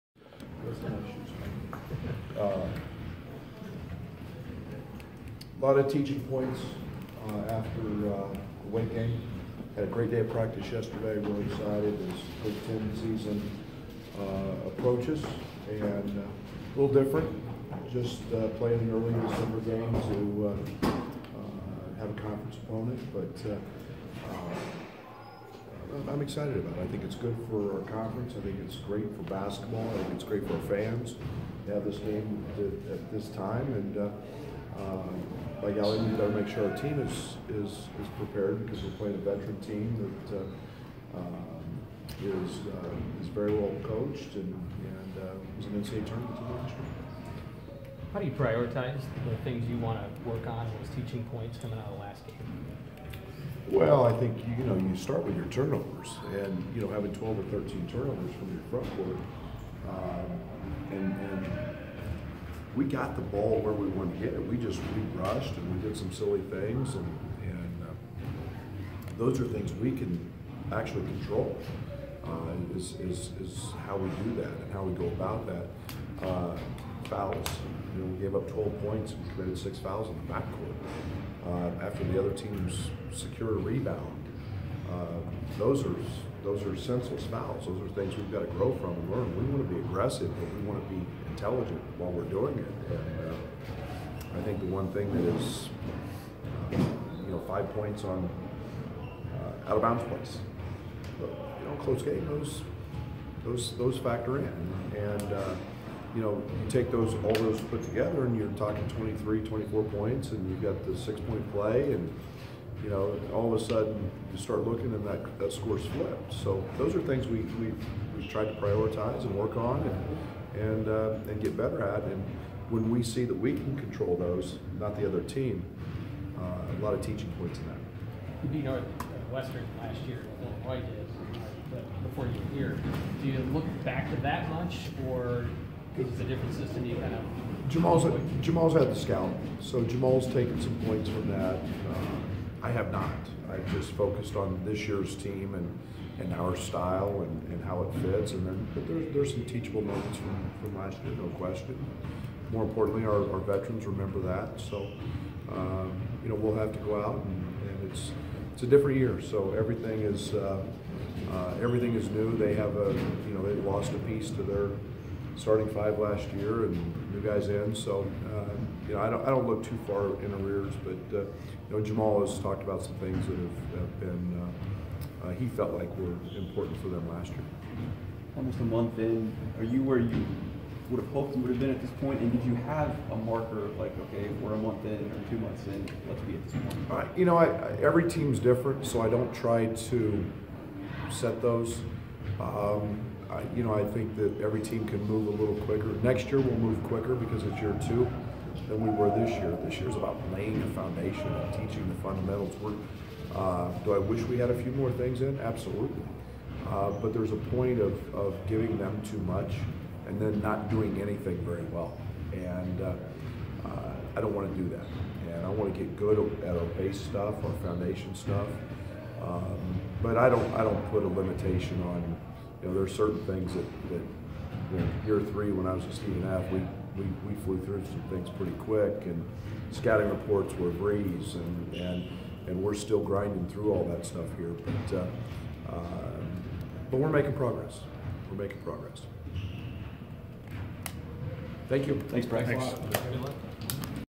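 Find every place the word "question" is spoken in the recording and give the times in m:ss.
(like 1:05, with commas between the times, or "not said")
2:31.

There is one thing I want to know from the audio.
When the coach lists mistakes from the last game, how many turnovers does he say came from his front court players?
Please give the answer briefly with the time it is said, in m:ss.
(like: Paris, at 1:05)
12 or 13, at 0:57.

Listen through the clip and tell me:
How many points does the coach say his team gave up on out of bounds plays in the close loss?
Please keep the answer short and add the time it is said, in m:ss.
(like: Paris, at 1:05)
5, at 1:37.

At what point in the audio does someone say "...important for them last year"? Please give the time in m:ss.
2:56.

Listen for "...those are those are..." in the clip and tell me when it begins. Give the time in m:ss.
1:25.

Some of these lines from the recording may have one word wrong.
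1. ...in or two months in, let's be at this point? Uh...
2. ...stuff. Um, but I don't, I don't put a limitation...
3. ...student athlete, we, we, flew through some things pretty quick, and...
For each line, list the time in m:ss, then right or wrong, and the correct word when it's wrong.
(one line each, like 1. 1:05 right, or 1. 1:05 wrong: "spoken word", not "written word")
1. 3:04 right
2. 3:38 right
3. 3:45 right.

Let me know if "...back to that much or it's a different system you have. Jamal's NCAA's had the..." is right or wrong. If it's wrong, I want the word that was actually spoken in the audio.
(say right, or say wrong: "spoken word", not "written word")
wrong: "Jamal", not "NCAA".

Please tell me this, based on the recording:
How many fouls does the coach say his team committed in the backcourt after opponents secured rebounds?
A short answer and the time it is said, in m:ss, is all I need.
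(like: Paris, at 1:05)
6, at 1:19.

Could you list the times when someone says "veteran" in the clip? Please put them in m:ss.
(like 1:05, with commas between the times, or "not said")
0:39, 2:33.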